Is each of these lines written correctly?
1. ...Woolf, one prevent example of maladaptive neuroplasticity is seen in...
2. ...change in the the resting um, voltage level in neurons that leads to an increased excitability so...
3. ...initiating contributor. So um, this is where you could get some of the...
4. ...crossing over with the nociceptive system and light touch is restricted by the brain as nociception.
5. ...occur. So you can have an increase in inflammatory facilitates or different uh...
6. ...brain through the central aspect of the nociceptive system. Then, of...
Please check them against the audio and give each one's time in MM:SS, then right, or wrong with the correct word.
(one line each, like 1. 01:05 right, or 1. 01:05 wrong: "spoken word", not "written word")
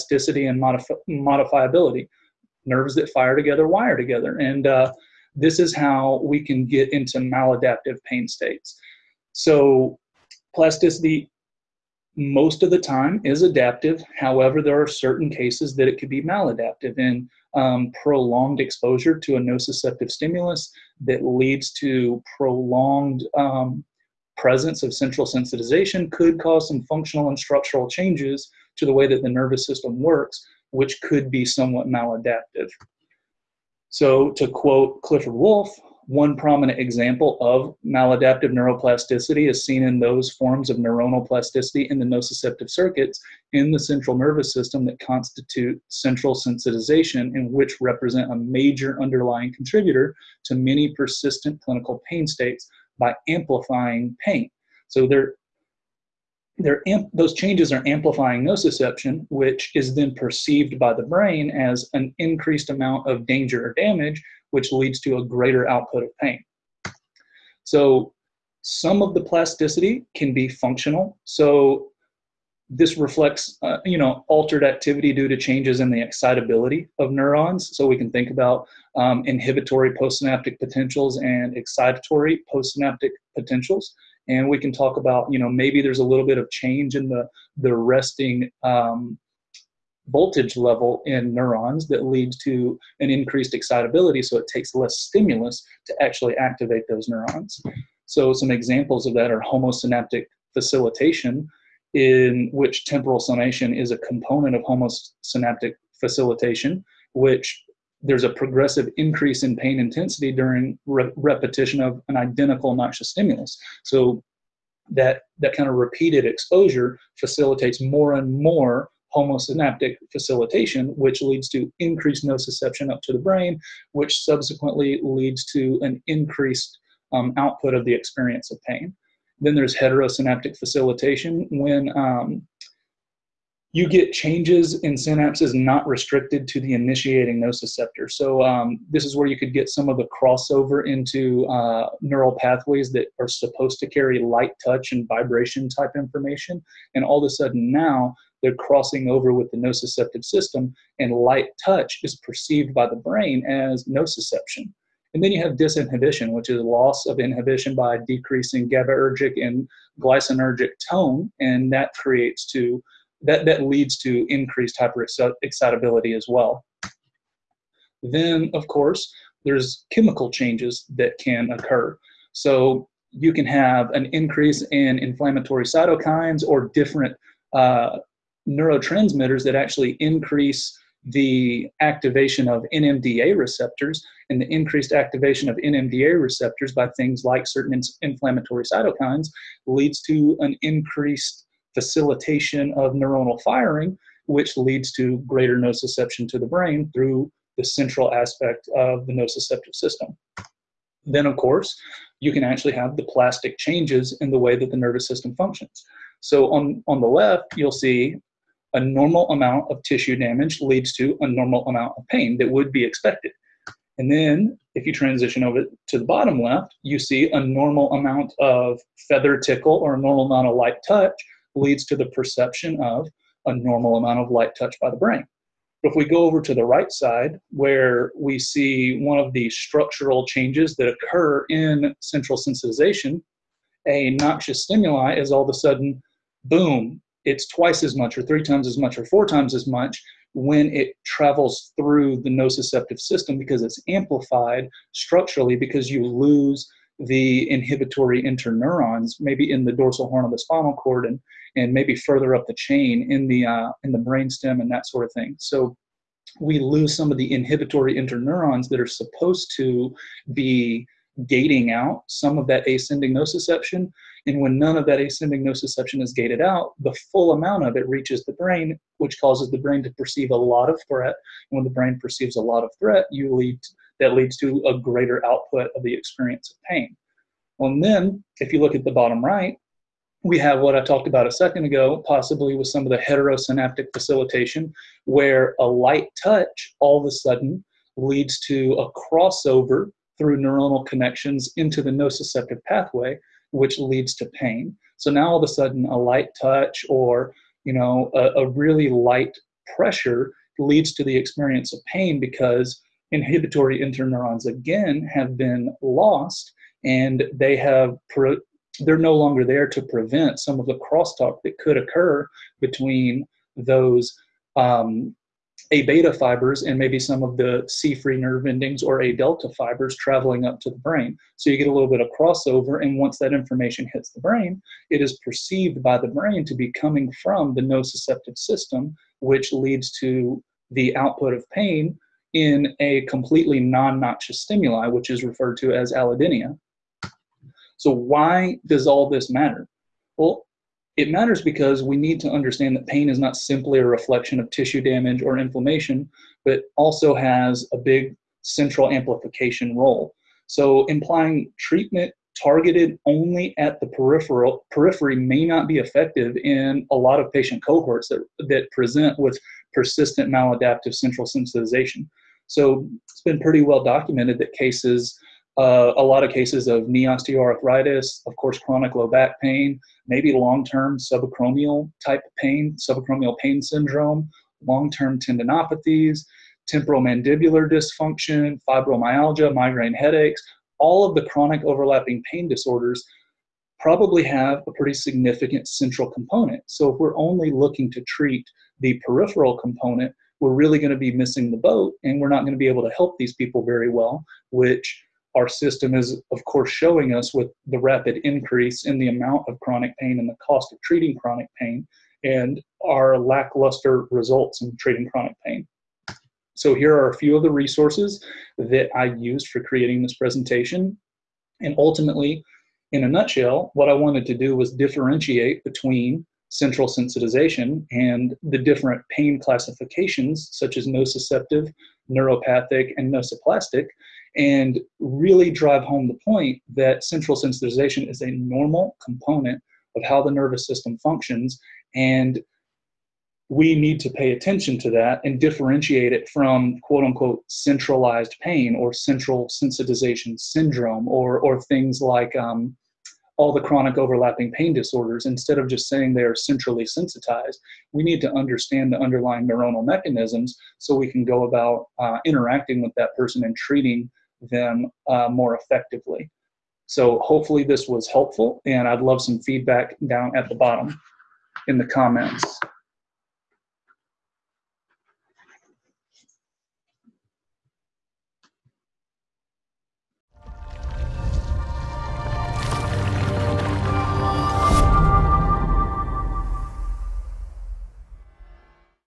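1. 00:35 wrong: "prominent", not "prevent"
2. 01:26 right
3. 02:16 wrong: "nociceptor", not "contributor"
4. 02:28 wrong: "perceived", not "restricted"
5. 02:51 wrong: "cytokines", not "facilitates"
6. 03:16 right.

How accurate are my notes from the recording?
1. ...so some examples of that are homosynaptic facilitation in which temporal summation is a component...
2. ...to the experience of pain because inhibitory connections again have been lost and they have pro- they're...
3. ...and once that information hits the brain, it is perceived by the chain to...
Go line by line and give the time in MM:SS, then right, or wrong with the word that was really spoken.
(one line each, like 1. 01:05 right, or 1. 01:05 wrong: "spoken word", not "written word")
1. 01:38 right
2. 05:00 wrong: "interneurons", not "connections"
3. 05:22 wrong: "brain", not "chain".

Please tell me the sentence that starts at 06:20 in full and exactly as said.
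All of the chronic overlapping pain disorders probably have a pretty significant central component.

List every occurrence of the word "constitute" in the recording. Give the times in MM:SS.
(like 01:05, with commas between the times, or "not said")
00:44.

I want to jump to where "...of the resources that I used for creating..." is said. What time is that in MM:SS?
06:47.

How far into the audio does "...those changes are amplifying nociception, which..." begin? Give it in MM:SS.
00:57.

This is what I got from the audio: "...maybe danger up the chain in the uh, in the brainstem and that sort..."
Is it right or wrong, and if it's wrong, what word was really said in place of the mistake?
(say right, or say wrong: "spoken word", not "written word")
wrong: "further", not "danger".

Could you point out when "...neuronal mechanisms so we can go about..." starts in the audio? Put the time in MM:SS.
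07:29.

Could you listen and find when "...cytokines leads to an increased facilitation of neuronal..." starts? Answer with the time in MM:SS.
03:08.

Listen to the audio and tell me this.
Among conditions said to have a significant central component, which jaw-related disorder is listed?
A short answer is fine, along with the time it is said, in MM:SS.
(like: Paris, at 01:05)
temporomandibular dysfunction, at 06:16.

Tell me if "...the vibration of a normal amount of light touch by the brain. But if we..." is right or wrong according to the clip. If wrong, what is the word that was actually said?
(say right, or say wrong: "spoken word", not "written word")
wrong: "perception", not "vibration".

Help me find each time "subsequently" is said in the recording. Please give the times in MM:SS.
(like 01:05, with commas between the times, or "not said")
02:04.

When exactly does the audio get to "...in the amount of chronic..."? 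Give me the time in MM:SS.
06:38.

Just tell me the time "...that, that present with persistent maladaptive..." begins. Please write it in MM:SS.
05:58.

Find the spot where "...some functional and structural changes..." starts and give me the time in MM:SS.
00:26.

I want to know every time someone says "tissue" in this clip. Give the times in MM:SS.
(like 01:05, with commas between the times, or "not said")
03:29, 05:44.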